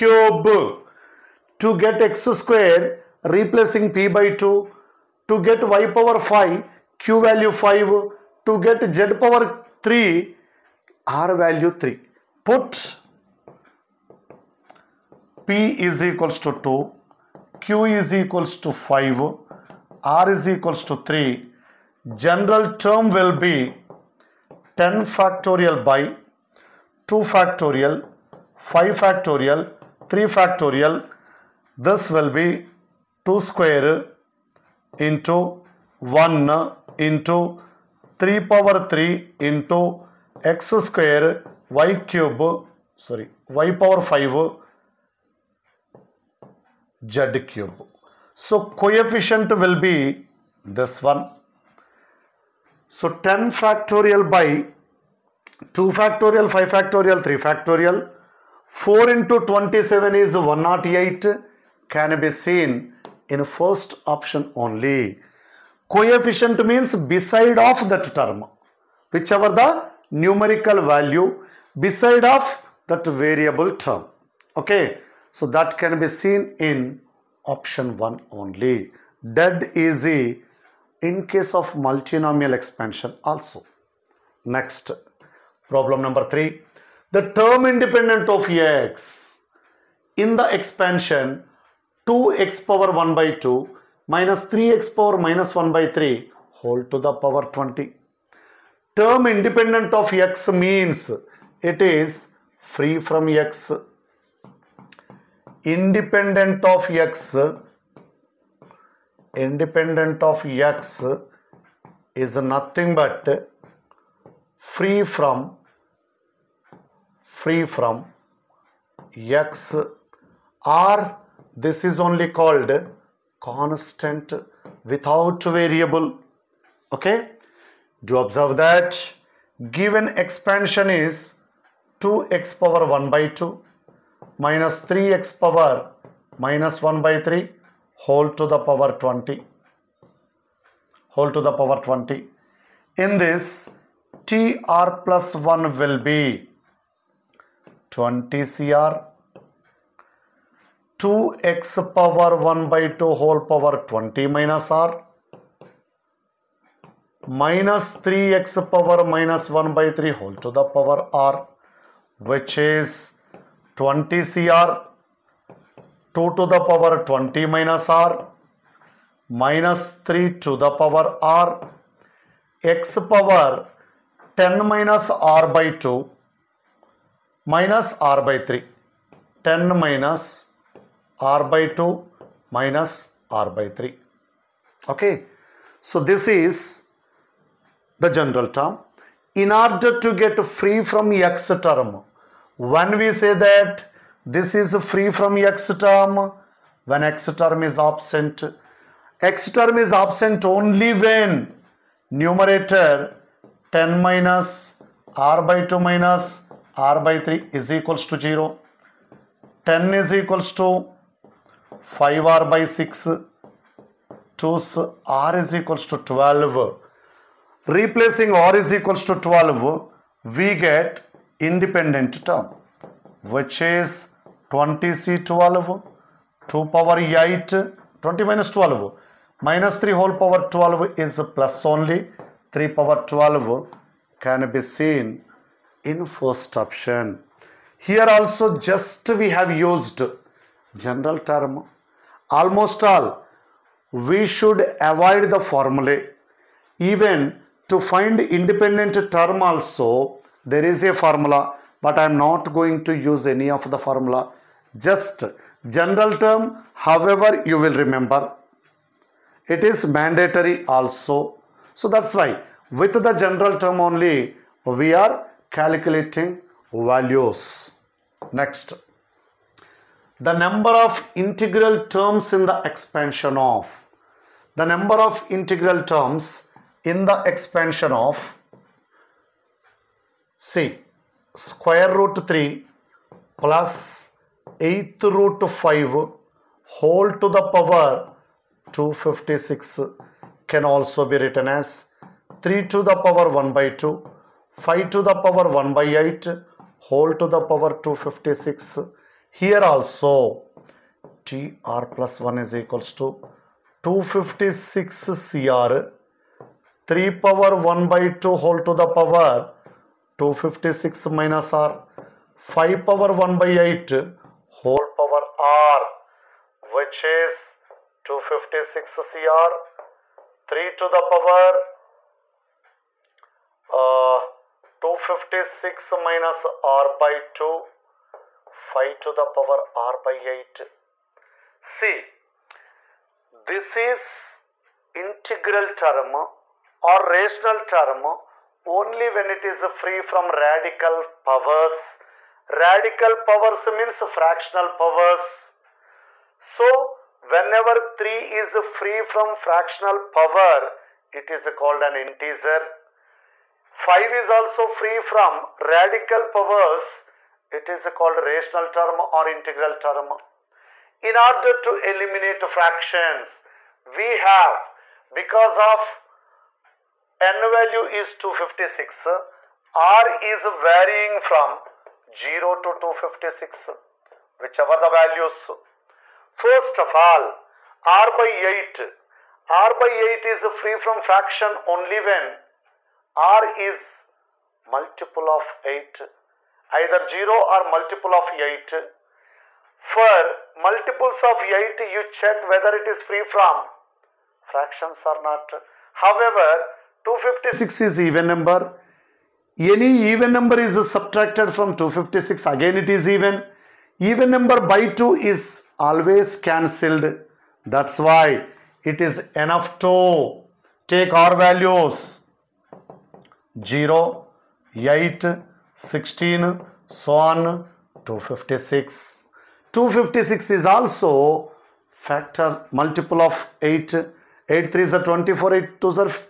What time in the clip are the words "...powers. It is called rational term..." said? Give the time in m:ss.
5:56.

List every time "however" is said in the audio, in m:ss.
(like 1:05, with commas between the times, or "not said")
4:16, 6:36.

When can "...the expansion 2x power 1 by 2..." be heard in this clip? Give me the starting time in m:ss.
1:30.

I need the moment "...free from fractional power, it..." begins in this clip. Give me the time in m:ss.
5:48.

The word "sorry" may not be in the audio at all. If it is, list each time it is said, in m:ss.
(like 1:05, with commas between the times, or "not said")
0:42.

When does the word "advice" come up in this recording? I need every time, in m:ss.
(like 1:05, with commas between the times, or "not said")
not said.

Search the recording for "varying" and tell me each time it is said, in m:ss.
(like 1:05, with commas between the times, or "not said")
6:10.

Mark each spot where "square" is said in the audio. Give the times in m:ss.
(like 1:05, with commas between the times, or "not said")
0:02, 0:33, 0:40, 4:41.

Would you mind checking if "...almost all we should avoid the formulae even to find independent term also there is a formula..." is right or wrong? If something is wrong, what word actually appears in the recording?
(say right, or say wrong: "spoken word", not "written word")
right.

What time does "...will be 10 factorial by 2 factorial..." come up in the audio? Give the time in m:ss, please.
0:23.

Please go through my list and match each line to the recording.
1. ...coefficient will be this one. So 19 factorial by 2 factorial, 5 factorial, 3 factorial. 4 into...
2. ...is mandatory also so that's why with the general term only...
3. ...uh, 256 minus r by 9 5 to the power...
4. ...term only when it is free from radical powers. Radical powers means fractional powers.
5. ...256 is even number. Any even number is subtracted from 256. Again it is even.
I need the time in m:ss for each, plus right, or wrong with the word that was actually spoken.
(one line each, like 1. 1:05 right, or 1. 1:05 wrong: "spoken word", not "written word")
1. 0:48 wrong: "10", not "19"
2. 4:19 right
3. 5:23 wrong: "2", not "9"
4. 5:37 right
5. 6:37 right.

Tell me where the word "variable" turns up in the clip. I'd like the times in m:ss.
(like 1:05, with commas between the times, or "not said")
1:13, 2:05.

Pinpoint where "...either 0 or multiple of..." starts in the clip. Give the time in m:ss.
6:26.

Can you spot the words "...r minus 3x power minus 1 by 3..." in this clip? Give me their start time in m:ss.
2:34.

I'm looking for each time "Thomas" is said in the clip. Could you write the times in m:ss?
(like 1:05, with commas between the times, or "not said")
not said.